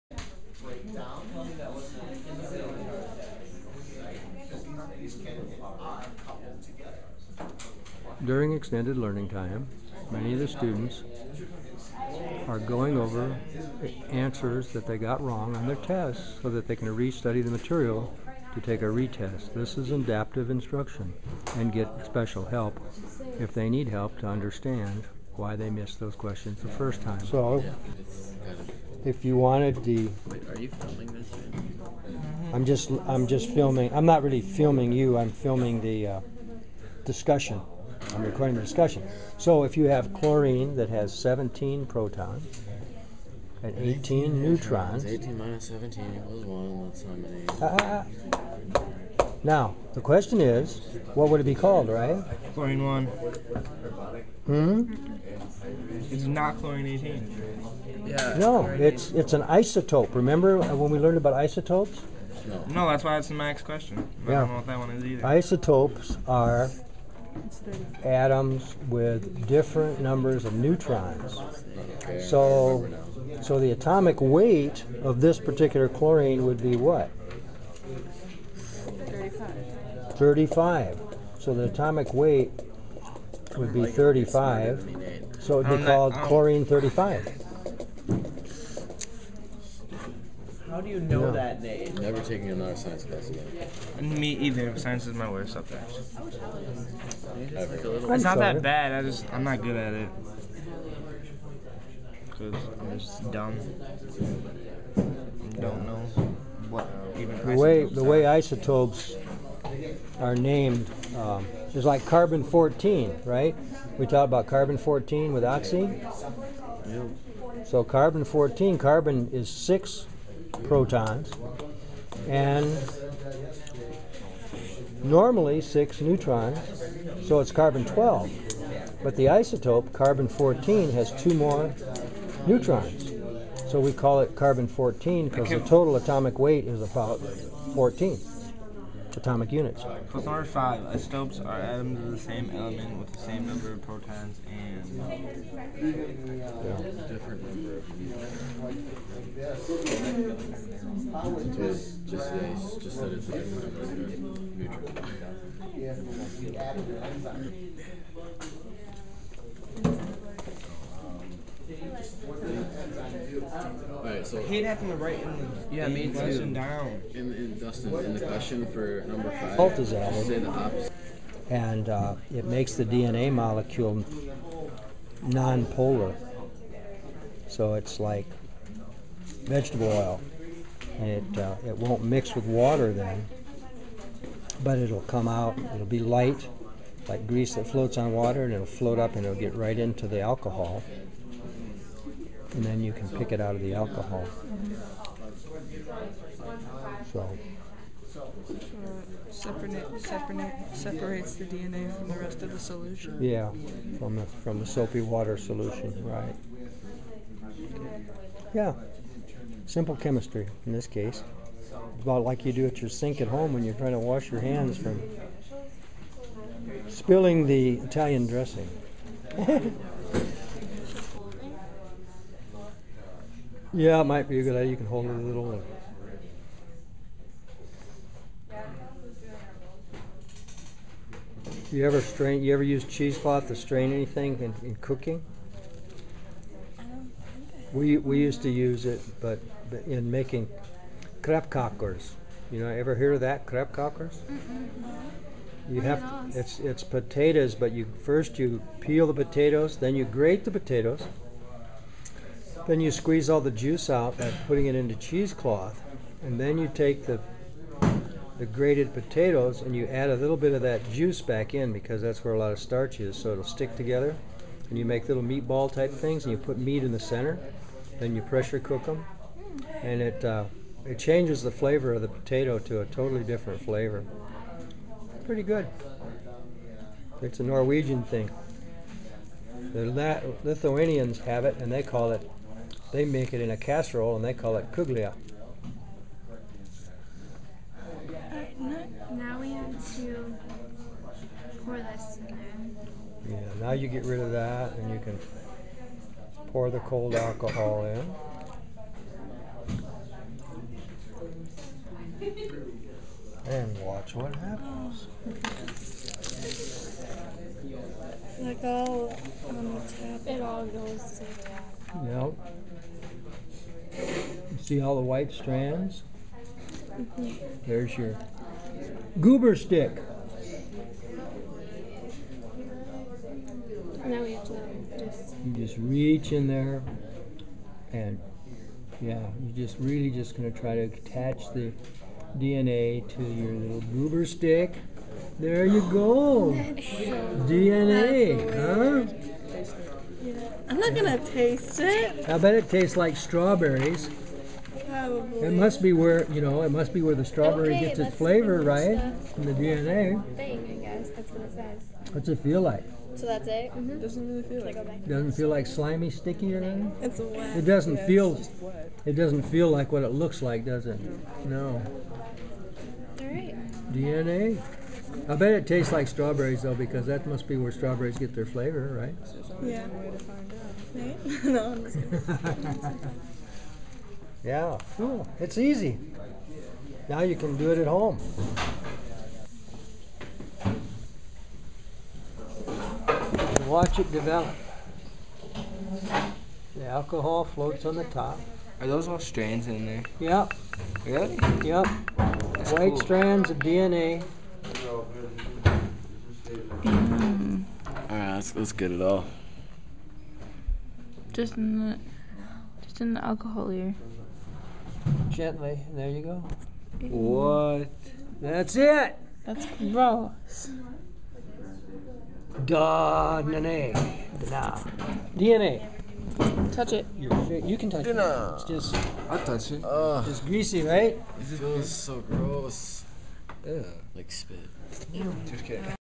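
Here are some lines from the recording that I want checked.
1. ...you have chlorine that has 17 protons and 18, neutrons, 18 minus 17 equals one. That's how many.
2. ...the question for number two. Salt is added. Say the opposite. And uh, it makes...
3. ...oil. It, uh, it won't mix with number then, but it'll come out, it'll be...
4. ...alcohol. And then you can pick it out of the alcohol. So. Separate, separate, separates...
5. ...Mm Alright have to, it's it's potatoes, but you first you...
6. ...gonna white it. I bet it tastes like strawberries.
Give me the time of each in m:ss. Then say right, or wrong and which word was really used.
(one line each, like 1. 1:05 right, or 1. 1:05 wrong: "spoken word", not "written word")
1. 0:39 right
2. 2:48 wrong: "five", not "two"
3. 2:59 wrong: "water", not "number"
4. 3:10 right
5. 4:03 wrong: "You", not "Alright"
6. 5:40 wrong: "taste", not "white".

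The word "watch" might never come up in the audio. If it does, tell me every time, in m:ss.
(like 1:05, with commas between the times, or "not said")
5:03, 6:23.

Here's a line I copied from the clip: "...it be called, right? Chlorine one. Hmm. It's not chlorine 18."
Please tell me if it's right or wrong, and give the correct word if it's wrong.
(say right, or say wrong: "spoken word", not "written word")
right.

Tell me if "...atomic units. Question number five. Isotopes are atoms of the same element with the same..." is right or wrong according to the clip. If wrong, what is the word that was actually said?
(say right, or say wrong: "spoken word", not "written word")
right.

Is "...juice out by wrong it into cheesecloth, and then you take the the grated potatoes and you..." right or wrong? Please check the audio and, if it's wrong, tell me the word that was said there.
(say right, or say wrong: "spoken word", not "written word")
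wrong: "putting", not "wrong".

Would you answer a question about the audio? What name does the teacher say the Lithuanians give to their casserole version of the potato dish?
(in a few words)
kuglia.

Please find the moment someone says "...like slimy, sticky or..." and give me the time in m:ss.
5:55.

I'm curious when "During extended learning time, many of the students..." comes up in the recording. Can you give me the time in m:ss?
0:08.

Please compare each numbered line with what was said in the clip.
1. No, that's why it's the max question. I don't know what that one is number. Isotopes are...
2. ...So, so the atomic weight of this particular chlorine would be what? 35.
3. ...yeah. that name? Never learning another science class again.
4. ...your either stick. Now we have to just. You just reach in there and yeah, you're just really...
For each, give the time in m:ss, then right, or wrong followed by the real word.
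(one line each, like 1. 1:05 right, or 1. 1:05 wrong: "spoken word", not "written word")
1. 1:02 wrong: "either", not "number"
2. 1:12 right
3. 1:31 wrong: "taking", not "learning"
4. 5:17 wrong: "goober", not "either".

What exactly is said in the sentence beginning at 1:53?
We talked about carbon 14 with oxy.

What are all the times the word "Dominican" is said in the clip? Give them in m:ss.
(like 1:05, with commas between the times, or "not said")
not said.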